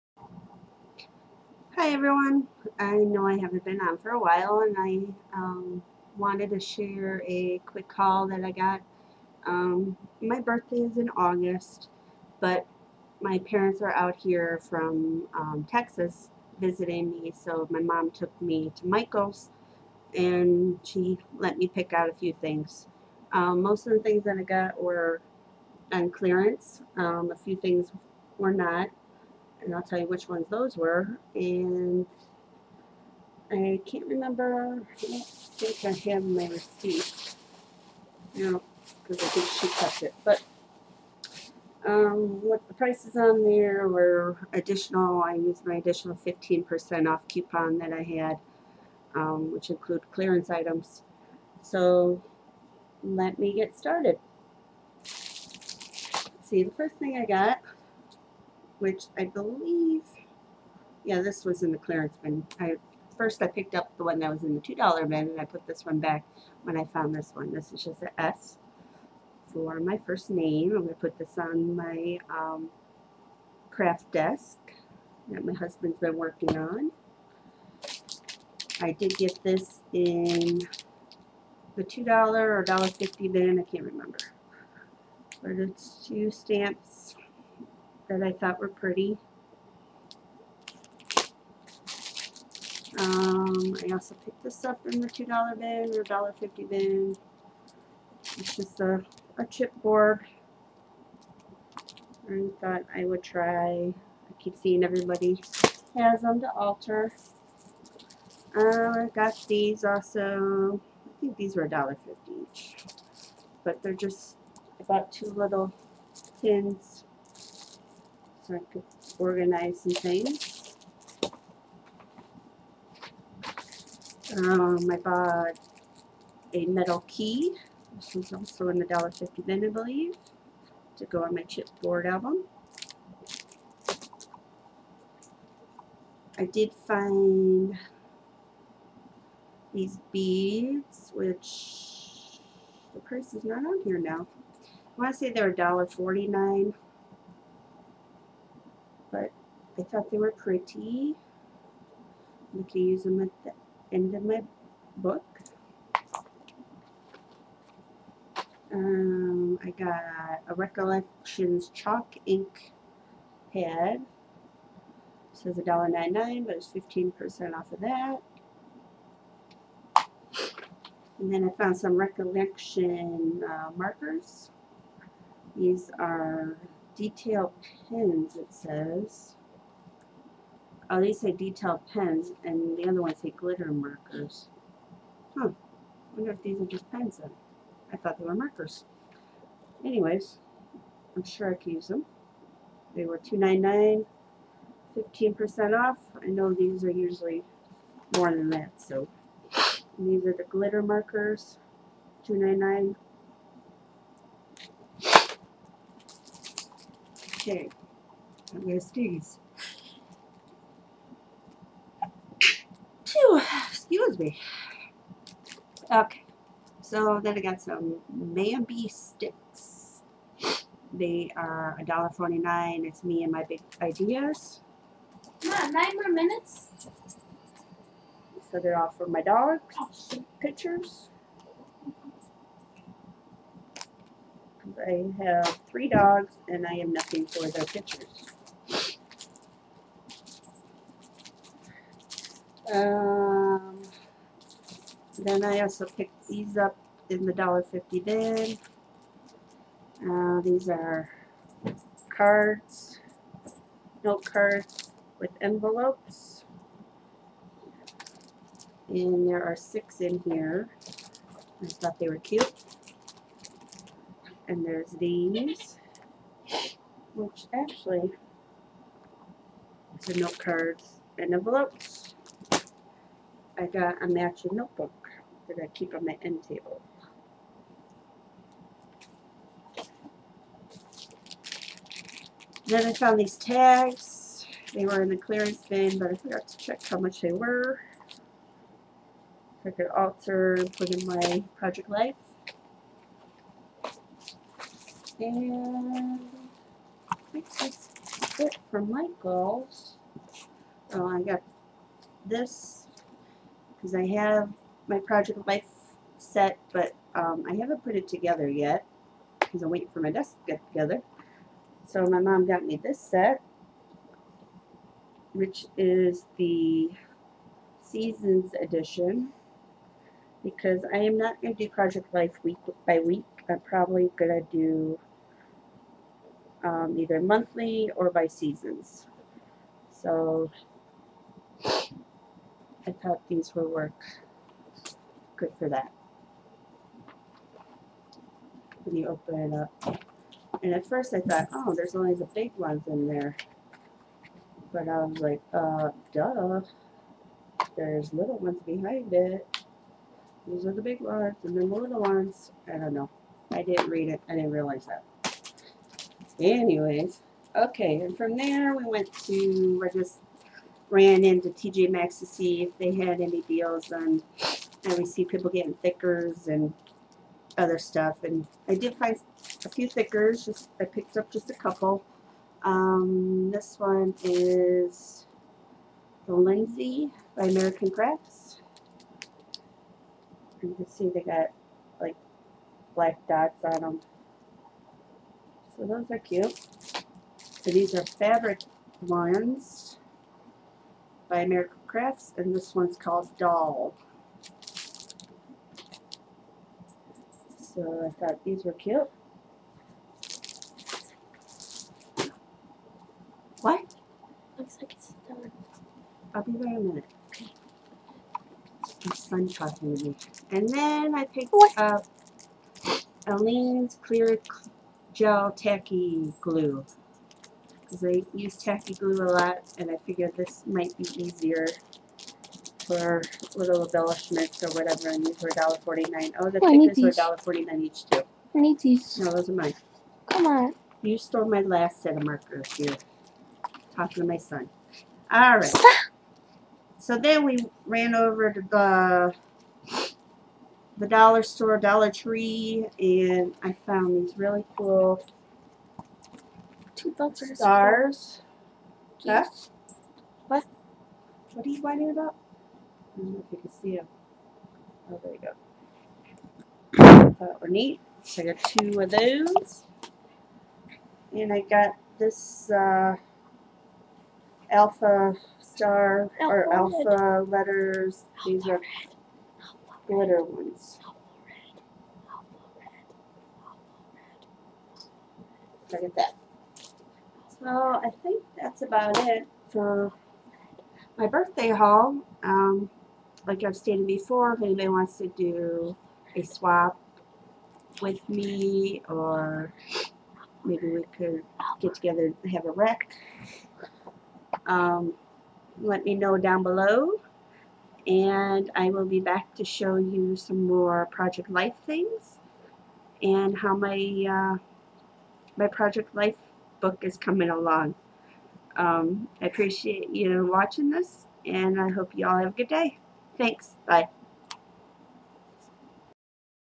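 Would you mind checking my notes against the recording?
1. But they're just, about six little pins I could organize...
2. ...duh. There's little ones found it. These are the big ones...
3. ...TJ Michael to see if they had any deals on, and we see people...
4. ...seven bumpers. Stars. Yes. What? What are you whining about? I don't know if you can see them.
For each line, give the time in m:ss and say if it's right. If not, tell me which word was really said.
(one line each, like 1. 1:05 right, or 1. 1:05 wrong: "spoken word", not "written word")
1. 1:53 wrong: "two", not "six"
2. 5:46 wrong: "behind", not "found"
3. 6:01 wrong: "Maxx", not "Michael"
4. 7:27 wrong: "two", not "seven".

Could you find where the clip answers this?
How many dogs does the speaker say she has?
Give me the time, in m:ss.
3:55.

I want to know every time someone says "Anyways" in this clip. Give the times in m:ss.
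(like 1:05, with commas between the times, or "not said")
3:09, 5:56.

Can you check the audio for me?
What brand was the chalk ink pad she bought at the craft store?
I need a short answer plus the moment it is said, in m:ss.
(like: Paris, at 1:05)
Recollections, at 2:40.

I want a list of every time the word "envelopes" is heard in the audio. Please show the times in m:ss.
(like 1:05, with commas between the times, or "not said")
4:15, 4:31.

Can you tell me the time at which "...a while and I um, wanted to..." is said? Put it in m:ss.
0:04.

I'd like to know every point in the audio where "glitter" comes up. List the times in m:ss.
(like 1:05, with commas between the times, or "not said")
3:03, 3:20, 7:50.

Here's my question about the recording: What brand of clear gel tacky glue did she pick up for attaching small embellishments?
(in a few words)
Aleene's.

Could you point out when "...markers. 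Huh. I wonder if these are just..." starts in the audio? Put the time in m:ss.
3:03.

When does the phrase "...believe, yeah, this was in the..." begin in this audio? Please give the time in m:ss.
0:59.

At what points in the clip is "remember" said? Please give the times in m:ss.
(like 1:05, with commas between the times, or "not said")
0:34, 1:23.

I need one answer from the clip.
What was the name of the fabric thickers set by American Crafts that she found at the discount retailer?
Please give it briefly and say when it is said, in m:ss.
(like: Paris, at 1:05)
Doll, at 6:33.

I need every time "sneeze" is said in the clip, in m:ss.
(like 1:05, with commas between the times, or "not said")
3:28.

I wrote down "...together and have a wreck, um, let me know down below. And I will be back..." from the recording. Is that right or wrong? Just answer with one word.
right.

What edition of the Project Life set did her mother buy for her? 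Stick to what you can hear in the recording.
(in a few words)
Seasons Edition.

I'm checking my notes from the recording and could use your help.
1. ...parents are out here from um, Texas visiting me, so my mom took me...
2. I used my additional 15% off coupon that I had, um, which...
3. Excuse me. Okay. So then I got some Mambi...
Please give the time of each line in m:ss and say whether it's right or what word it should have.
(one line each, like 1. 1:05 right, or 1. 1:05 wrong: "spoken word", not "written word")
1. 0:13 right
2. 0:45 right
3. 3:34 right.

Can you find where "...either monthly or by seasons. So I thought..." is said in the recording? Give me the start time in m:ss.
5:26.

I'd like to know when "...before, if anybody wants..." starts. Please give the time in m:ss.
8:04.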